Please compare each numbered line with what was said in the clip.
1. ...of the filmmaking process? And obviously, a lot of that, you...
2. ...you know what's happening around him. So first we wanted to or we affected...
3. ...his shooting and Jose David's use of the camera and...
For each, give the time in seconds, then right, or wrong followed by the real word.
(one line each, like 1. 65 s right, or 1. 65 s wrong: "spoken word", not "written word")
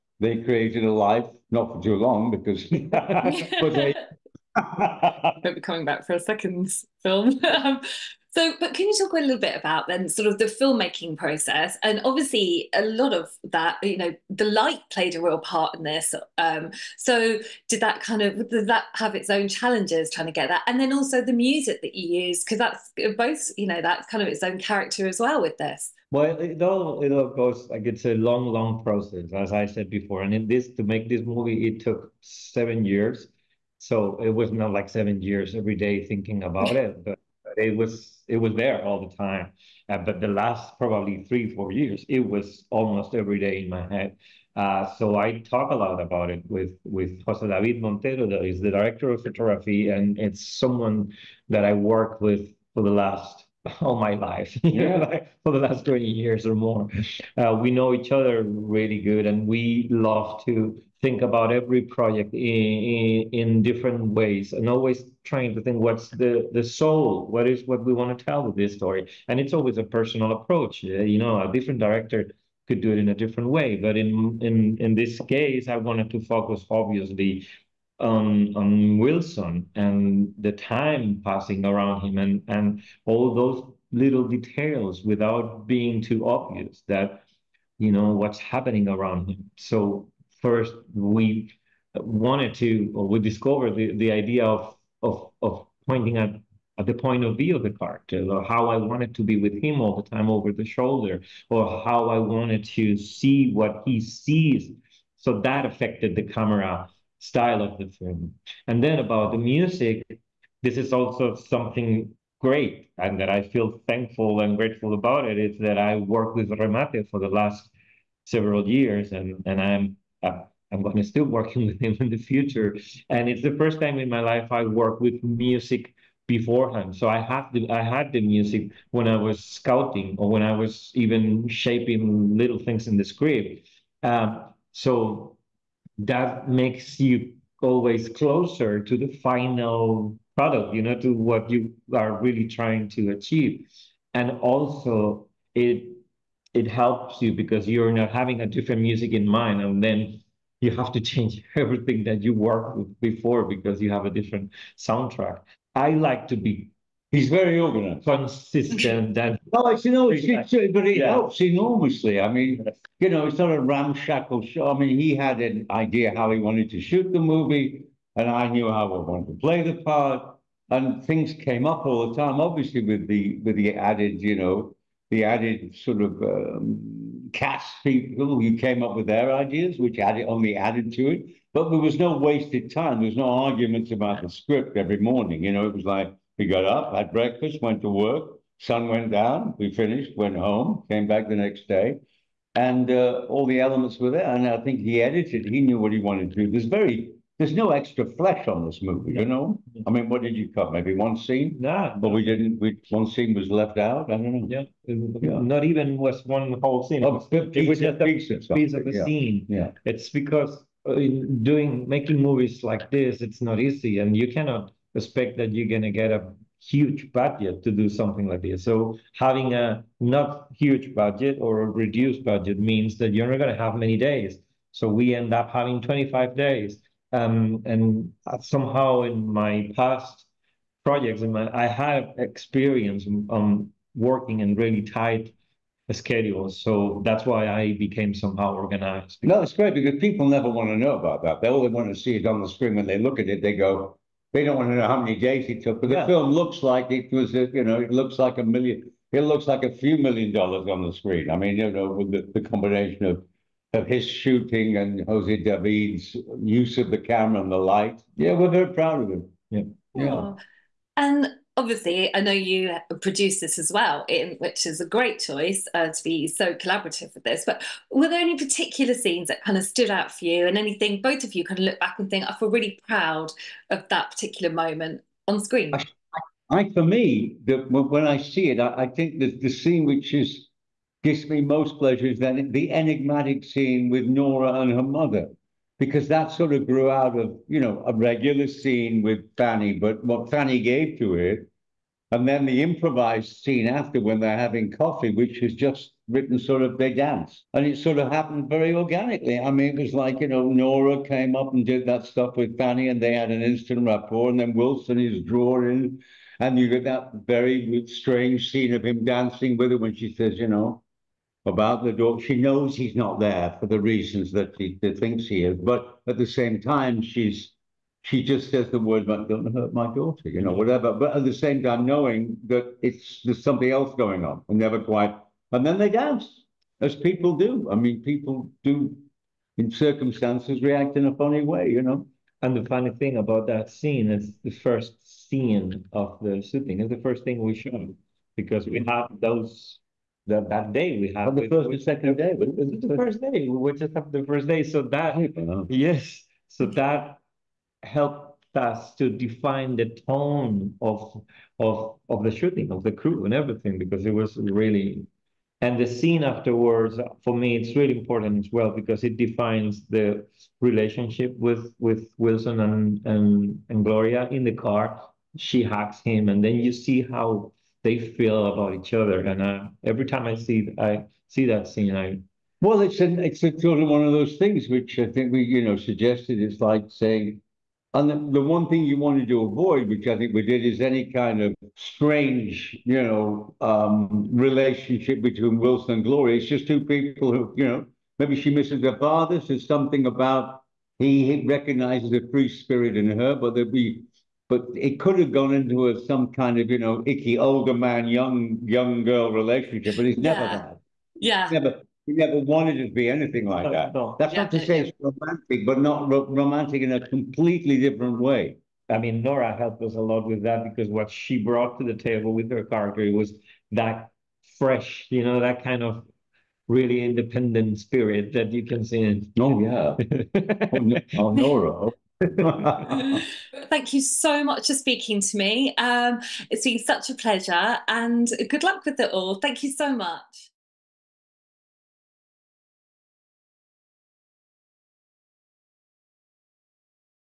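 1. 10 s right
2. 87 s wrong: "discovered", not "affected"
3. 253 s right.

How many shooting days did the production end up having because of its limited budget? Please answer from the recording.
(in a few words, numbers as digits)
25.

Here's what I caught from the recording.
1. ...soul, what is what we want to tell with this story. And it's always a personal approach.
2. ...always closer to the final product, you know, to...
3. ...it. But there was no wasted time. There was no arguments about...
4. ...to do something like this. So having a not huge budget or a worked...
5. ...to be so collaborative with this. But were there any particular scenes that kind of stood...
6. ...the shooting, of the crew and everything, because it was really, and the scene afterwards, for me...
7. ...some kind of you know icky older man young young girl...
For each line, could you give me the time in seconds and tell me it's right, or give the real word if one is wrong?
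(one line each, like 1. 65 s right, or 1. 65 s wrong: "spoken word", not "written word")
1. 66 s right
2. 137 s right
3. 181 s right
4. 217 s wrong: "reduced", not "worked"
5. 265 s right
6. 352 s right
7. 396 s right.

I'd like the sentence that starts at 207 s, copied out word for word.
Oh, it, was just a piece of the yeah.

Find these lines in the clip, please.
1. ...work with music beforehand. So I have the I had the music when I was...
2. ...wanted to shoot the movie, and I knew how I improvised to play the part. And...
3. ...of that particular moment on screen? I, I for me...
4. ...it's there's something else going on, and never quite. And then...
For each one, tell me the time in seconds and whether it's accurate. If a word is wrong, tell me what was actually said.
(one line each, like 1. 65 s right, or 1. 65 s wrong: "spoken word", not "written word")
1. 124 s right
2. 166 s wrong: "wanted", not "improvised"
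3. 273 s right
4. 322 s right.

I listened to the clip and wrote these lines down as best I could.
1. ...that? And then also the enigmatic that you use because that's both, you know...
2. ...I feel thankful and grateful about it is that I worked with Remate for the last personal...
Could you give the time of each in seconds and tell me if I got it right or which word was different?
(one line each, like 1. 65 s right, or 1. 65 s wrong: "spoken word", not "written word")
1. 20 s wrong: "music", not "enigmatic"
2. 113 s wrong: "several", not "personal".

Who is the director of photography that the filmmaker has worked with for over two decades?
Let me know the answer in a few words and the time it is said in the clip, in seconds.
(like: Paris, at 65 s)
Jose David Montero, at 47 s.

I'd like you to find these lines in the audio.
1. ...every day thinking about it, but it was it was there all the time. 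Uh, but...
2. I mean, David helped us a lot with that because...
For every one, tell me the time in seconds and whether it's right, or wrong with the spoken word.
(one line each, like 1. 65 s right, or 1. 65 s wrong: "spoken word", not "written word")
1. 35 s right
2. 408 s wrong: "Nora", not "David".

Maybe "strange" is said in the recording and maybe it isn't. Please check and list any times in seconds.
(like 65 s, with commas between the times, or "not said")
307 s, 381 s.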